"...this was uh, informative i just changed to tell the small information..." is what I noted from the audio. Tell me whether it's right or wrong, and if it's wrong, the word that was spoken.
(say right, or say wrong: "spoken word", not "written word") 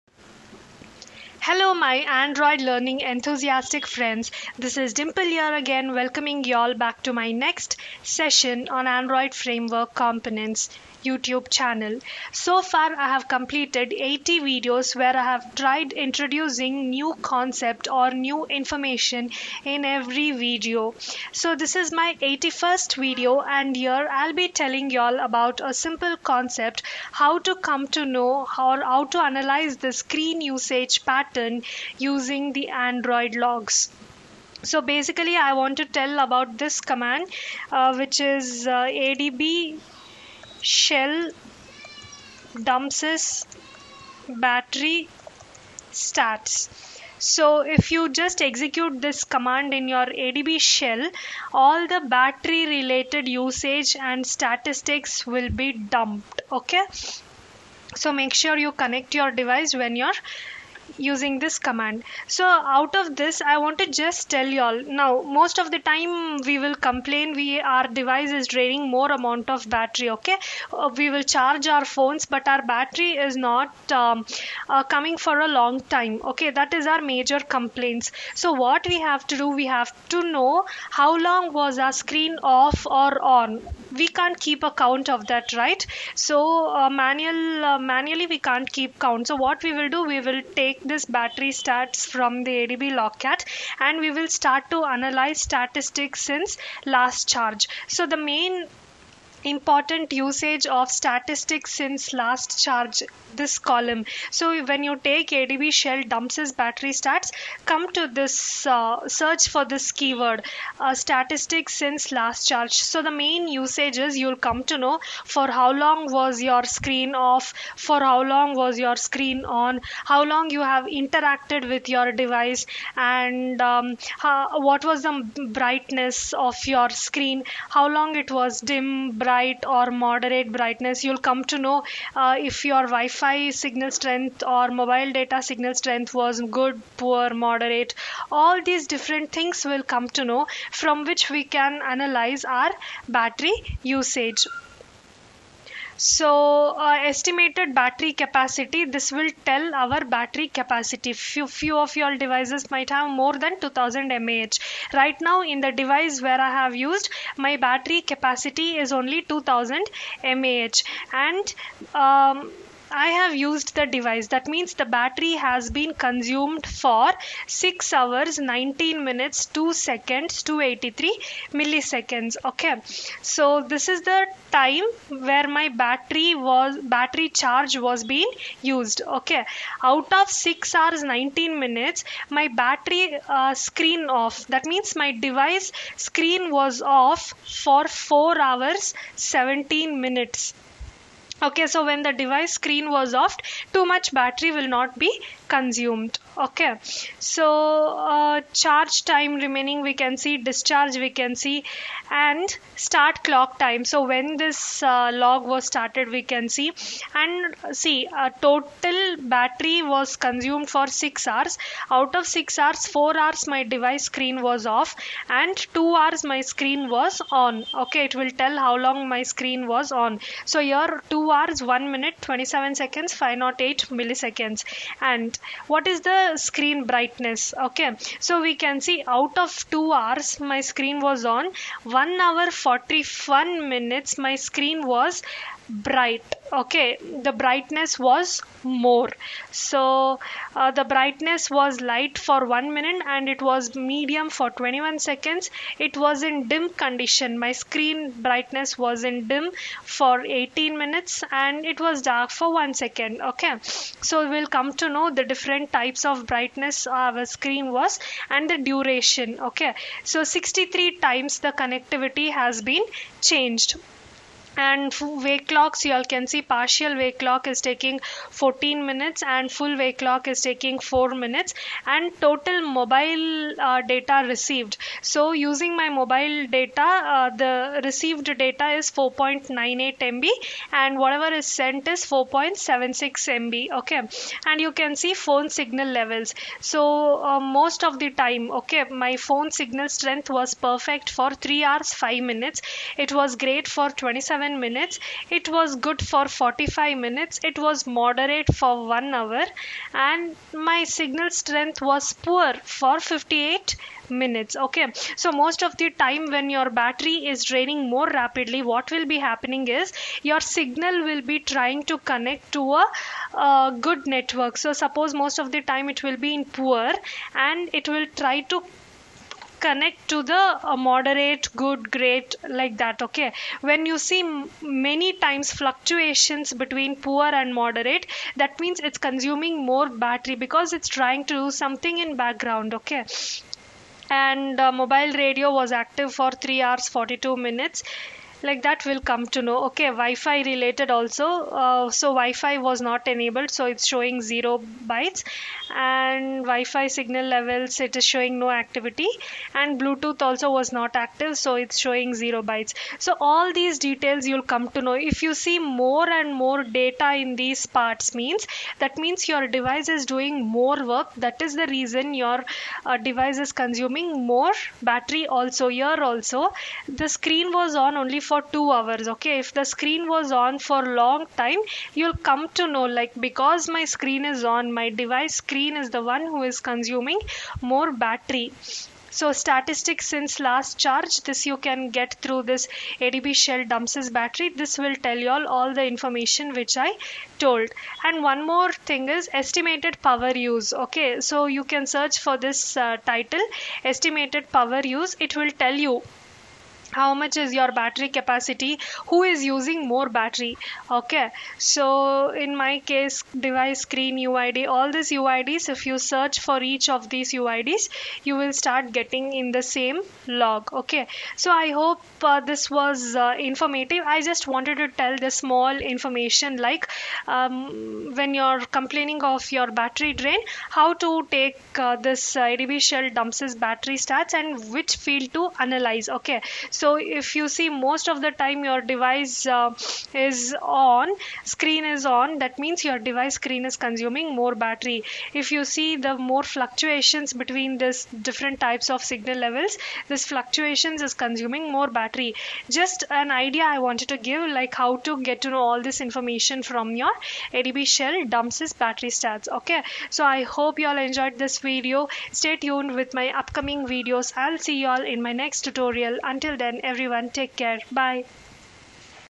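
wrong: "wanted", not "changed".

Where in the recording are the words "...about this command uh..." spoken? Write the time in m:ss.
0:36.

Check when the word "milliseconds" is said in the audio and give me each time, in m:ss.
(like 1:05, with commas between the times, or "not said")
2:51, 3:43.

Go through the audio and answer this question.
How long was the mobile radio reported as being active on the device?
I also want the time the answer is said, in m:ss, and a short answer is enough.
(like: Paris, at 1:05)
3 hours 42 minutes, at 5:36.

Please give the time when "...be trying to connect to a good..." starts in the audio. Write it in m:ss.
5:11.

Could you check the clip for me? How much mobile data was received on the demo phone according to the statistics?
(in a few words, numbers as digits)
4.98 MB.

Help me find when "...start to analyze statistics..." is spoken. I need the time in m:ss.
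1:34.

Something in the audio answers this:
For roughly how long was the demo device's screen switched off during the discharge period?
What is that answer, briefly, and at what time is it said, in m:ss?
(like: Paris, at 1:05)
4 hours, 17 minutes, at 3:07.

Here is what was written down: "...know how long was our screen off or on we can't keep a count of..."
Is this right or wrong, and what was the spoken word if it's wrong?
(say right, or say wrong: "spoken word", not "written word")
right.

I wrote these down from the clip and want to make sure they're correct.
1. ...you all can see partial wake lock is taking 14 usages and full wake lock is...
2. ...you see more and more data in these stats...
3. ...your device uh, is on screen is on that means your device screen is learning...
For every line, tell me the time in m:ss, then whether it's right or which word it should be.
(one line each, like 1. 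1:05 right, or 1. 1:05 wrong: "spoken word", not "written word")
1. 4:25 wrong: "minutes", not "usages"
2. 5:55 wrong: "parts", not "stats"
3. 7:08 wrong: "consuming", not "learning".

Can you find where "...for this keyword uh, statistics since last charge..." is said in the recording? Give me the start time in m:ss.
1:49.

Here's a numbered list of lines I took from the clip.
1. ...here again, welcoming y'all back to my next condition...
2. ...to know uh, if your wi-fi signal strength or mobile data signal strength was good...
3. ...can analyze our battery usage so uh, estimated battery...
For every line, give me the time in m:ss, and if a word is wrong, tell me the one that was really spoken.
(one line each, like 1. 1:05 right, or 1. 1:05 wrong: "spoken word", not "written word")
1. 0:05 wrong: "session", not "condition"
2. 2:11 right
3. 2:21 right.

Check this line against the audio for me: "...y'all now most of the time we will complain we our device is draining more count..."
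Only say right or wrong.
wrong.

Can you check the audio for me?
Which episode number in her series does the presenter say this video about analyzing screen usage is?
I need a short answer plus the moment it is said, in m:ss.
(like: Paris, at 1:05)
81st, at 0:22.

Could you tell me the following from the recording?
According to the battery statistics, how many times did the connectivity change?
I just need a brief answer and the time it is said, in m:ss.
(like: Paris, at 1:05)
63, at 4:20.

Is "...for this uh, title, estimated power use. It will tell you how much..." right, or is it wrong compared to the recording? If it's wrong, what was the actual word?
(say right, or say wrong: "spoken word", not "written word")
right.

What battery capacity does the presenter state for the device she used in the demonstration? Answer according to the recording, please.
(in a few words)
2000 mAh.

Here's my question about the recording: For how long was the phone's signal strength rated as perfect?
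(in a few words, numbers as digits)
3 hours 5 minutes.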